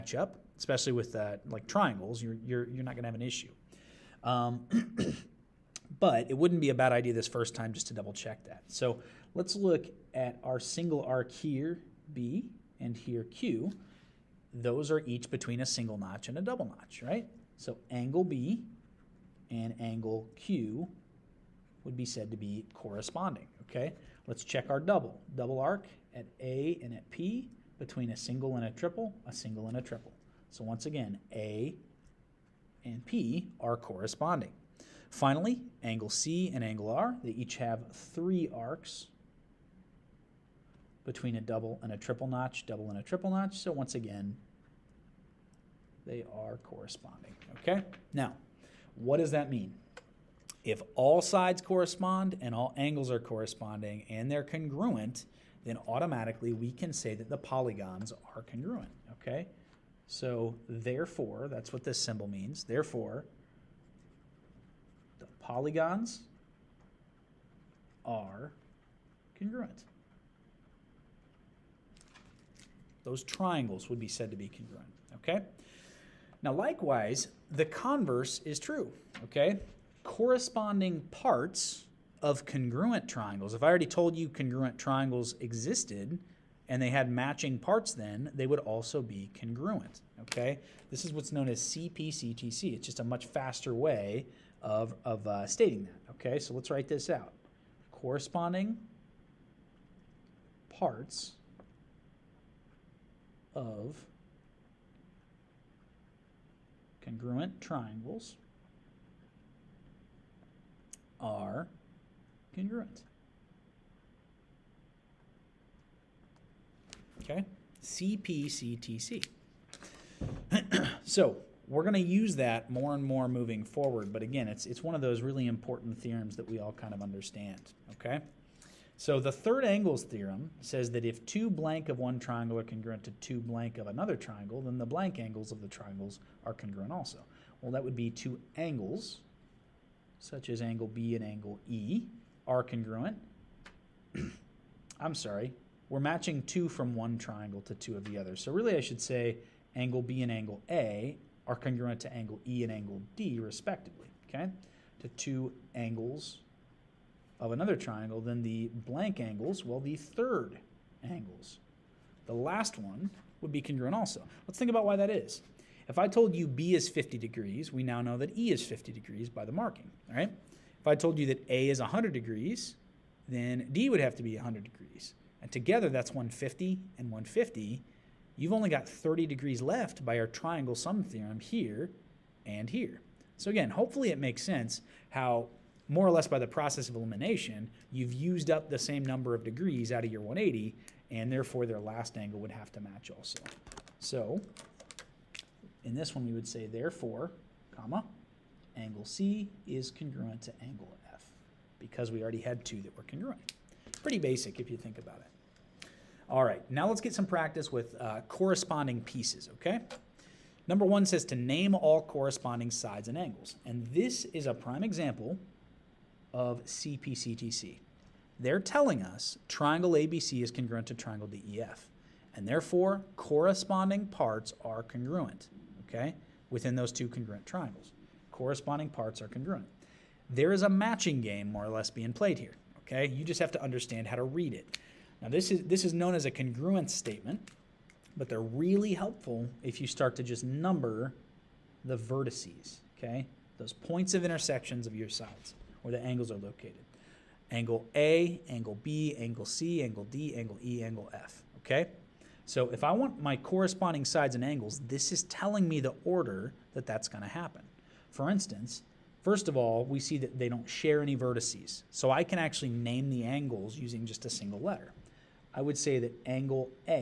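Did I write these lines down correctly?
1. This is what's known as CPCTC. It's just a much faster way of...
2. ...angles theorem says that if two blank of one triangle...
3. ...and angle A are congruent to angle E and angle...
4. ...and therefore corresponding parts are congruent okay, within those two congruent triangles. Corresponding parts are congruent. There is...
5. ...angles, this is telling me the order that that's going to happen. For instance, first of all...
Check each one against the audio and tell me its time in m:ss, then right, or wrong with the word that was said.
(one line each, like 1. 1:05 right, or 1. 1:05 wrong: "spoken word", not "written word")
1. 1:30 right
2. 2:09 right
3. 2:30 right
4. 3:42 right
5. 4:14 right.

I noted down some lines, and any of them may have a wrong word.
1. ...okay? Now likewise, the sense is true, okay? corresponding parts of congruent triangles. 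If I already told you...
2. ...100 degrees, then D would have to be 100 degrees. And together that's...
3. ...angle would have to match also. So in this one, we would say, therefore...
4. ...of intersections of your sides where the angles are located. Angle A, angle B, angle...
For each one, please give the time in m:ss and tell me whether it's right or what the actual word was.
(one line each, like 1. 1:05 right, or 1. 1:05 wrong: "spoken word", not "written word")
1. 1:15 wrong: "converse", not "sense"
2. 2:51 right
3. 3:12 right
4. 4:04 right.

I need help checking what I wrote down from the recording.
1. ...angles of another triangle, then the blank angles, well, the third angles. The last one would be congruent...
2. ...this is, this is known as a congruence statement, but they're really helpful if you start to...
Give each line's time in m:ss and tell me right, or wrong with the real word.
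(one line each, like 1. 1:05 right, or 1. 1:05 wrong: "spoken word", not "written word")
1. 2:35 right
2. 3:55 right.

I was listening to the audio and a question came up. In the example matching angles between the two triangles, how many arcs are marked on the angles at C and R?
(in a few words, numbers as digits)
3.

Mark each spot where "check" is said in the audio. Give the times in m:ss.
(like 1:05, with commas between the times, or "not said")
0:08, 0:24.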